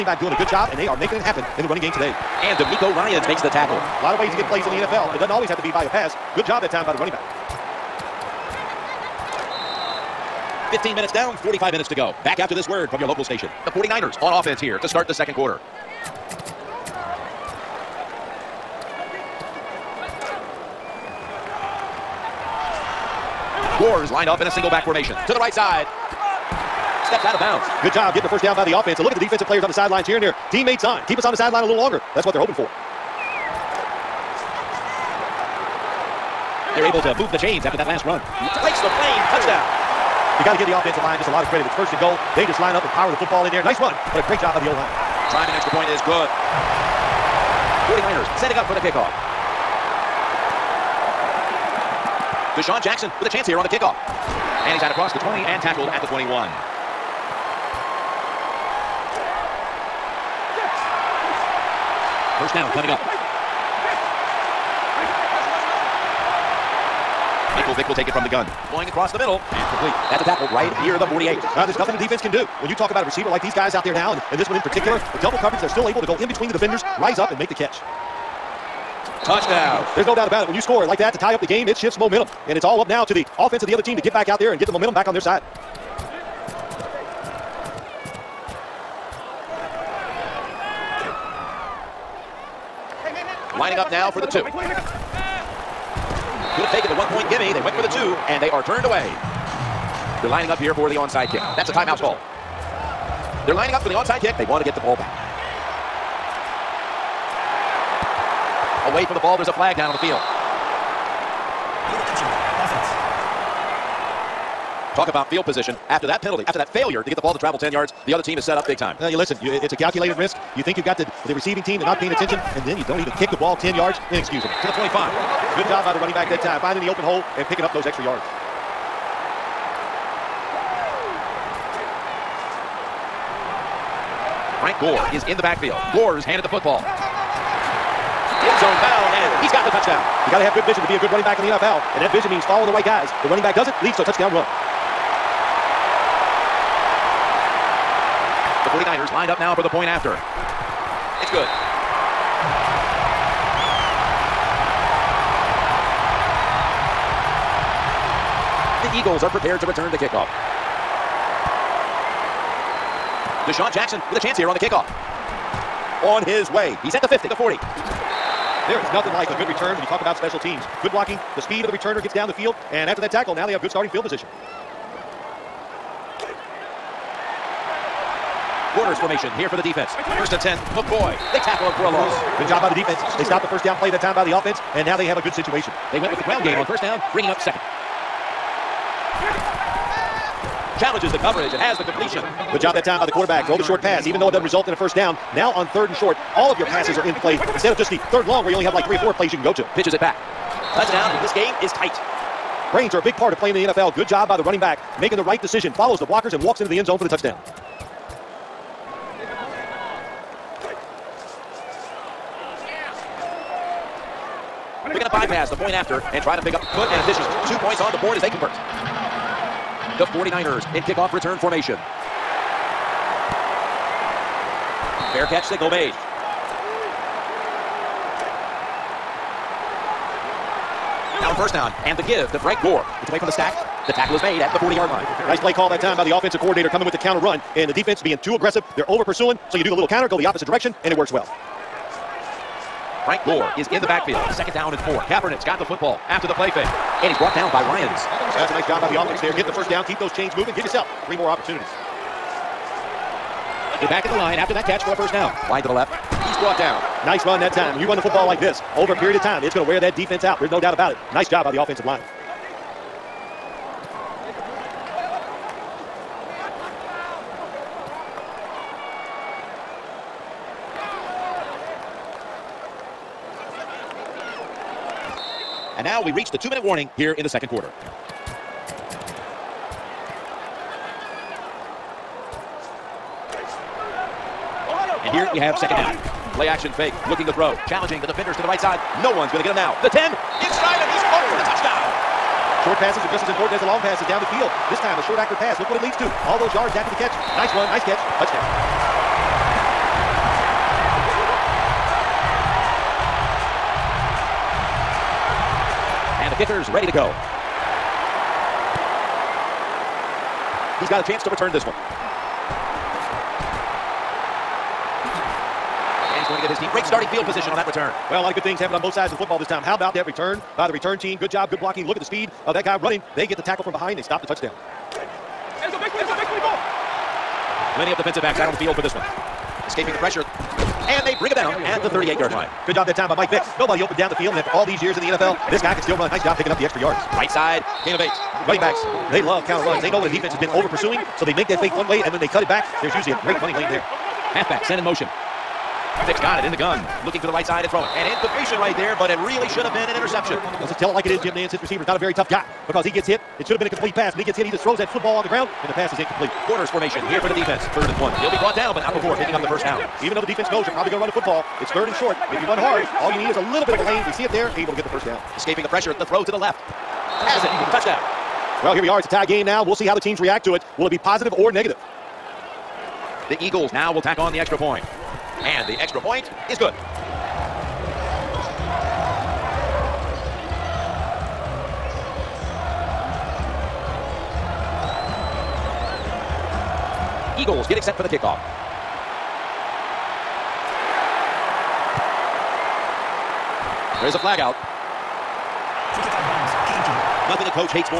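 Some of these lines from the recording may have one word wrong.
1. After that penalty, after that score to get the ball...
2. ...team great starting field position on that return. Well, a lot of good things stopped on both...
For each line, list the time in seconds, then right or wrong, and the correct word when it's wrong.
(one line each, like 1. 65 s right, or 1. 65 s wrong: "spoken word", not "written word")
1. 115 s wrong: "failure", not "score"
2. 316 s wrong: "happened", not "stopped".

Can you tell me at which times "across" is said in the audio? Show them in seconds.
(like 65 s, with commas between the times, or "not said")
54 s, 68 s.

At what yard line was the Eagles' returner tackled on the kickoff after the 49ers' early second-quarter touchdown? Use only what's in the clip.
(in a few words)
21.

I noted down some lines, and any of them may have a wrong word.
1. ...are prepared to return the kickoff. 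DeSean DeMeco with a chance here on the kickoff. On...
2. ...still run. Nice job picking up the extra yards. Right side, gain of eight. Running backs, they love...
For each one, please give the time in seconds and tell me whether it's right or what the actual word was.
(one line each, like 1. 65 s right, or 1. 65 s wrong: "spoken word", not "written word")
1. 159 s wrong: "Jackson", not "DeMeco"
2. 335 s right.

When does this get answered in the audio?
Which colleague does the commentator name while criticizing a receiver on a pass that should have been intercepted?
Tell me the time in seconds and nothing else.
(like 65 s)
351 s.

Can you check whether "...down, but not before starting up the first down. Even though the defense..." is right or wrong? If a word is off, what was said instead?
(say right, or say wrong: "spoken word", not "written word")
wrong: "picking", not "starting".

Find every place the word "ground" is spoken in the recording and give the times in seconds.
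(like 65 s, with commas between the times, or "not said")
186 s, 355 s.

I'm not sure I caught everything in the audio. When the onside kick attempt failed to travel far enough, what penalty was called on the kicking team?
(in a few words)
Illegal touching.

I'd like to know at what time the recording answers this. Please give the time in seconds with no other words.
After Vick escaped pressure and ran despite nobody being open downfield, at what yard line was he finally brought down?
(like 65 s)
331 s.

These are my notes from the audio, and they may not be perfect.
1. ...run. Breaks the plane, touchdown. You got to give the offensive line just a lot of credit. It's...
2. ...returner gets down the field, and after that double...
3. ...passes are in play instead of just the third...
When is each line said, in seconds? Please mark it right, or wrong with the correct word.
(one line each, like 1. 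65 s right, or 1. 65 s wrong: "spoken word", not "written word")
1. 38 s right
2. 171 s wrong: "tackle", not "double"
3. 196 s right.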